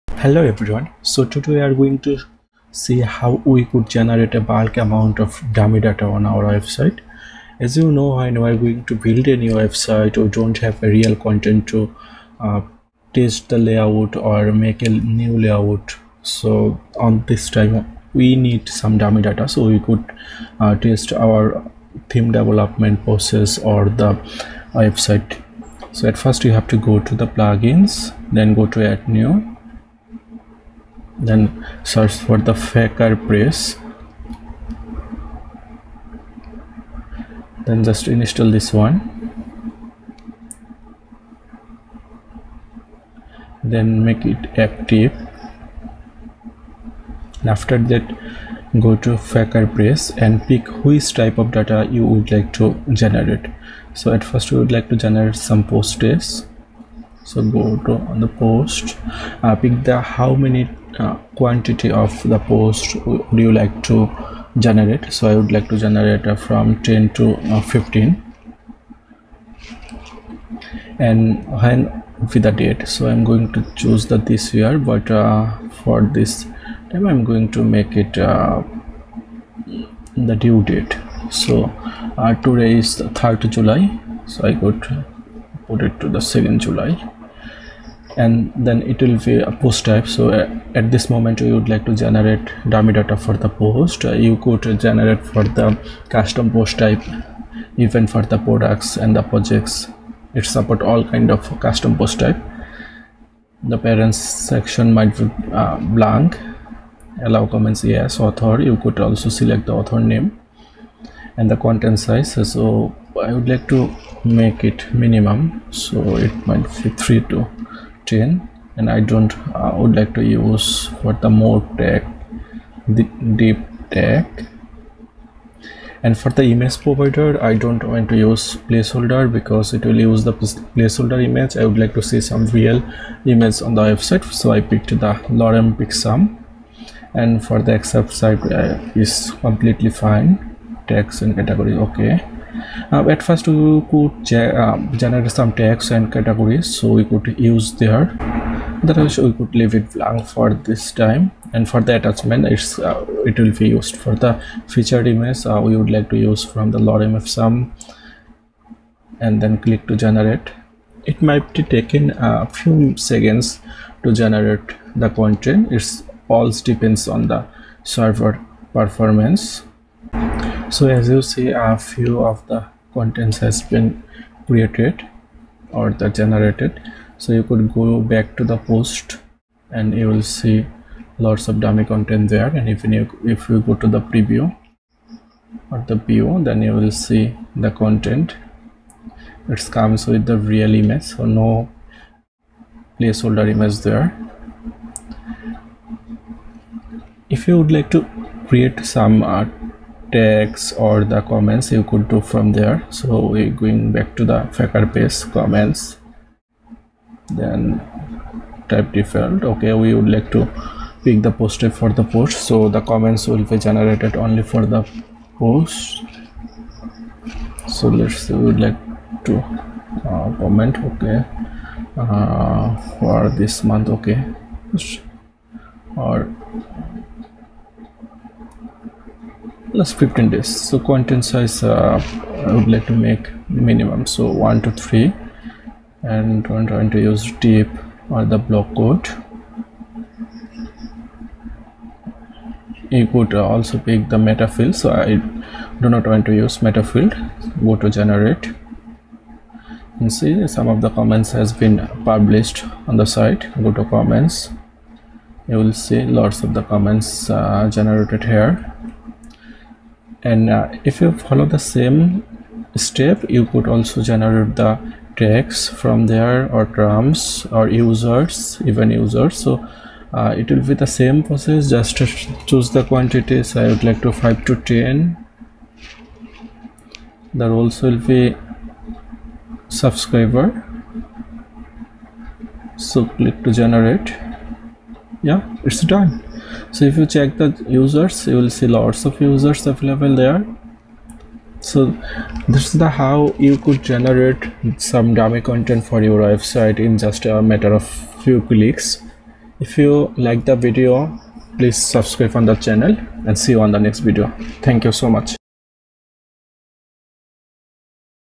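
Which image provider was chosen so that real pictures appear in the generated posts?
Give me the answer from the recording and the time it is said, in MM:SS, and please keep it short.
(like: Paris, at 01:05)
Lorem Picsum, at 02:15.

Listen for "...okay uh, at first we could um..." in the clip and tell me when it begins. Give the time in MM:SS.
02:21.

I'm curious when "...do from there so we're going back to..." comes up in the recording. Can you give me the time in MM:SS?
03:22.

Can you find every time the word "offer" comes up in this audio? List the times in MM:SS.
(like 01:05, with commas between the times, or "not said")
not said.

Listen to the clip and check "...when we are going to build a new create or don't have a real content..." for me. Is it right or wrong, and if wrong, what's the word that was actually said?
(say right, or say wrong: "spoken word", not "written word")
wrong: "website", not "create".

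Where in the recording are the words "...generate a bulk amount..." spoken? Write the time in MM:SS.
00:03.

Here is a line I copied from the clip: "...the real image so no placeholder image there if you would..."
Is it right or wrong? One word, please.
right.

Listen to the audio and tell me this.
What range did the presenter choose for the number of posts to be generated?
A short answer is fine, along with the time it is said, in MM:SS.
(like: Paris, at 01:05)
10 to 15, at 01:06.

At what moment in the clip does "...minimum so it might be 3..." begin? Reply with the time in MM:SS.
01:54.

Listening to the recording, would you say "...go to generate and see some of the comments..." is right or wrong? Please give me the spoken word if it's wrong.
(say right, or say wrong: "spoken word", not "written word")
right.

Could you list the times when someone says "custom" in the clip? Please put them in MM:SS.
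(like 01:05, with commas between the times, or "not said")
01:36, 01:41.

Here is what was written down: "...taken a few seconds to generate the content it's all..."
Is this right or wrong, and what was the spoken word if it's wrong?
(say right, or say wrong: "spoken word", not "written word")
right.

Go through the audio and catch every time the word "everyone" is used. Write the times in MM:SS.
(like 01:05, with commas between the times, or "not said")
00:00.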